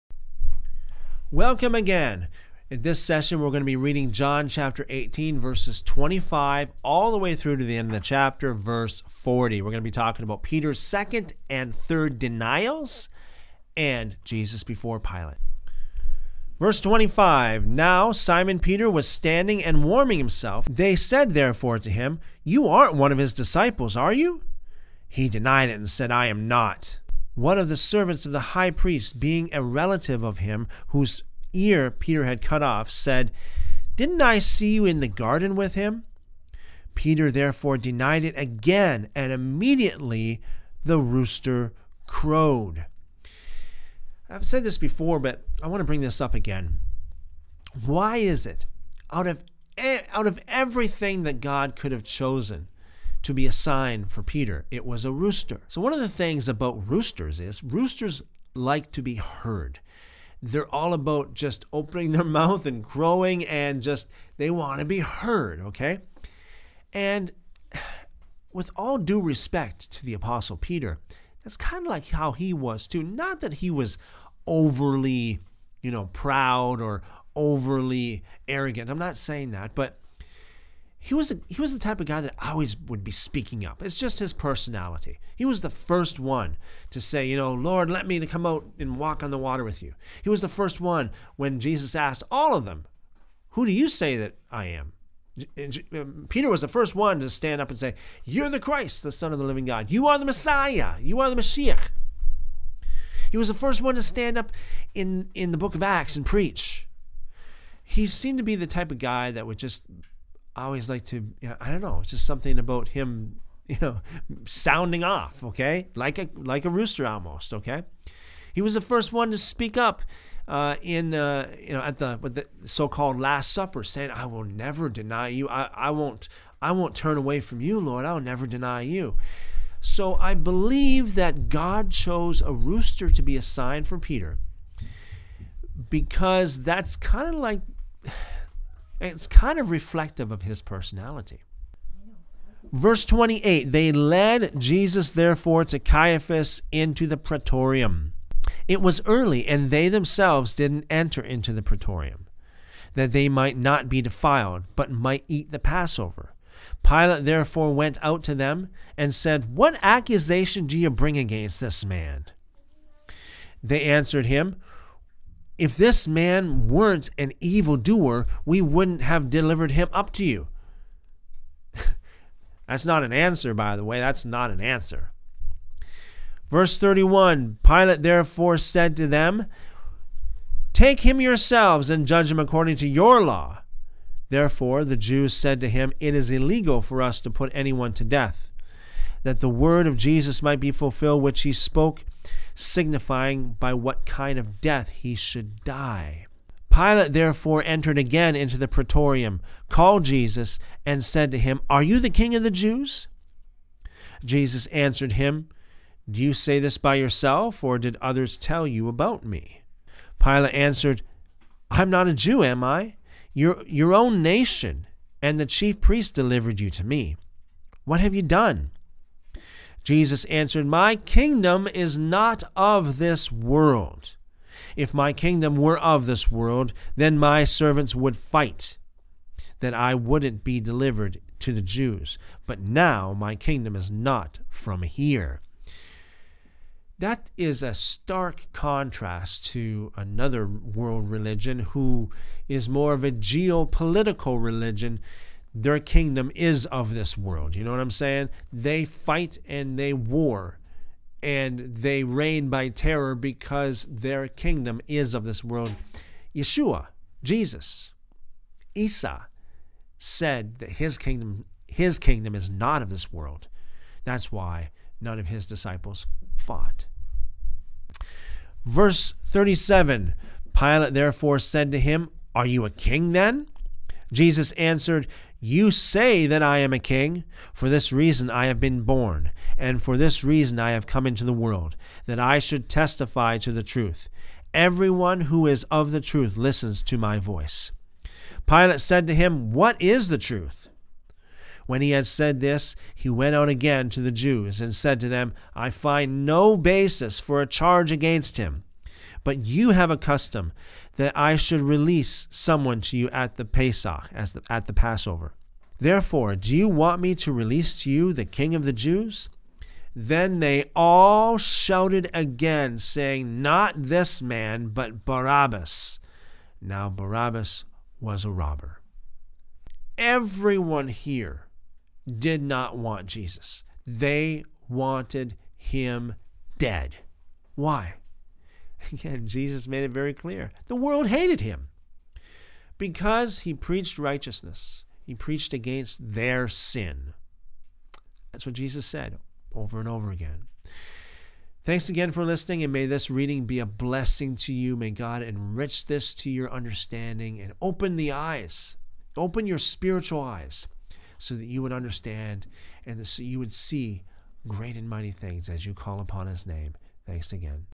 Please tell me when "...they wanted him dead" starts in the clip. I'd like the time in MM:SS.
05:23.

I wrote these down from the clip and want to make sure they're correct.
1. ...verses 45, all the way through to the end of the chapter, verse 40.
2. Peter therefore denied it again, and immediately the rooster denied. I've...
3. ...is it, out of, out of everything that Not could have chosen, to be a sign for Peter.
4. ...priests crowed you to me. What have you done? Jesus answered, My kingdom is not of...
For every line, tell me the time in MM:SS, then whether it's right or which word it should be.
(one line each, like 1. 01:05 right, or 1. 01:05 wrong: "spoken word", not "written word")
1. 00:05 wrong: "25", not "45"
2. 00:36 wrong: "crowed", not "denied"
3. 00:48 wrong: "God", not "Not"
4. 03:35 wrong: "delivered", not "crowed".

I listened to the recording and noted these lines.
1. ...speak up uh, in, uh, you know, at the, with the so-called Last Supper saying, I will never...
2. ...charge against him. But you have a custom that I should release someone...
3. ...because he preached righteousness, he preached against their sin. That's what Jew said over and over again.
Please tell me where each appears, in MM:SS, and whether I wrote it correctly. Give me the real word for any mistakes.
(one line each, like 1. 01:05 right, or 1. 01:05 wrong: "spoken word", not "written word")
1. 01:59 right
2. 04:57 right
3. 05:32 wrong: "Jesus", not "Jew".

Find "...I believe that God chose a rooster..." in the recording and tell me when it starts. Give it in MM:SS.
02:10.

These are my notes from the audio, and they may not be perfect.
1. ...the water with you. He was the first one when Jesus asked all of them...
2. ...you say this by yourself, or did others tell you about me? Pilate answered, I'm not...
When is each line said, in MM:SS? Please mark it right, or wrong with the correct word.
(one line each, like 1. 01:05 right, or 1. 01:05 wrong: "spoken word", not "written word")
1. 01:29 right
2. 03:26 right.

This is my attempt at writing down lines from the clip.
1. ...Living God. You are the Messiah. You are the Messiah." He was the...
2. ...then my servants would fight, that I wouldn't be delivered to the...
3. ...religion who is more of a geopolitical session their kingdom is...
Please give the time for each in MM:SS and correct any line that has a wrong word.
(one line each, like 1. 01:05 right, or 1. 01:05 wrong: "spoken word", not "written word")
1. 01:39 right
2. 03:46 right
3. 04:01 wrong: "religion", not "session".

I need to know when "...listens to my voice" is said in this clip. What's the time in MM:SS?
04:46.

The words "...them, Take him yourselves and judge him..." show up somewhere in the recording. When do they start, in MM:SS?
02:59.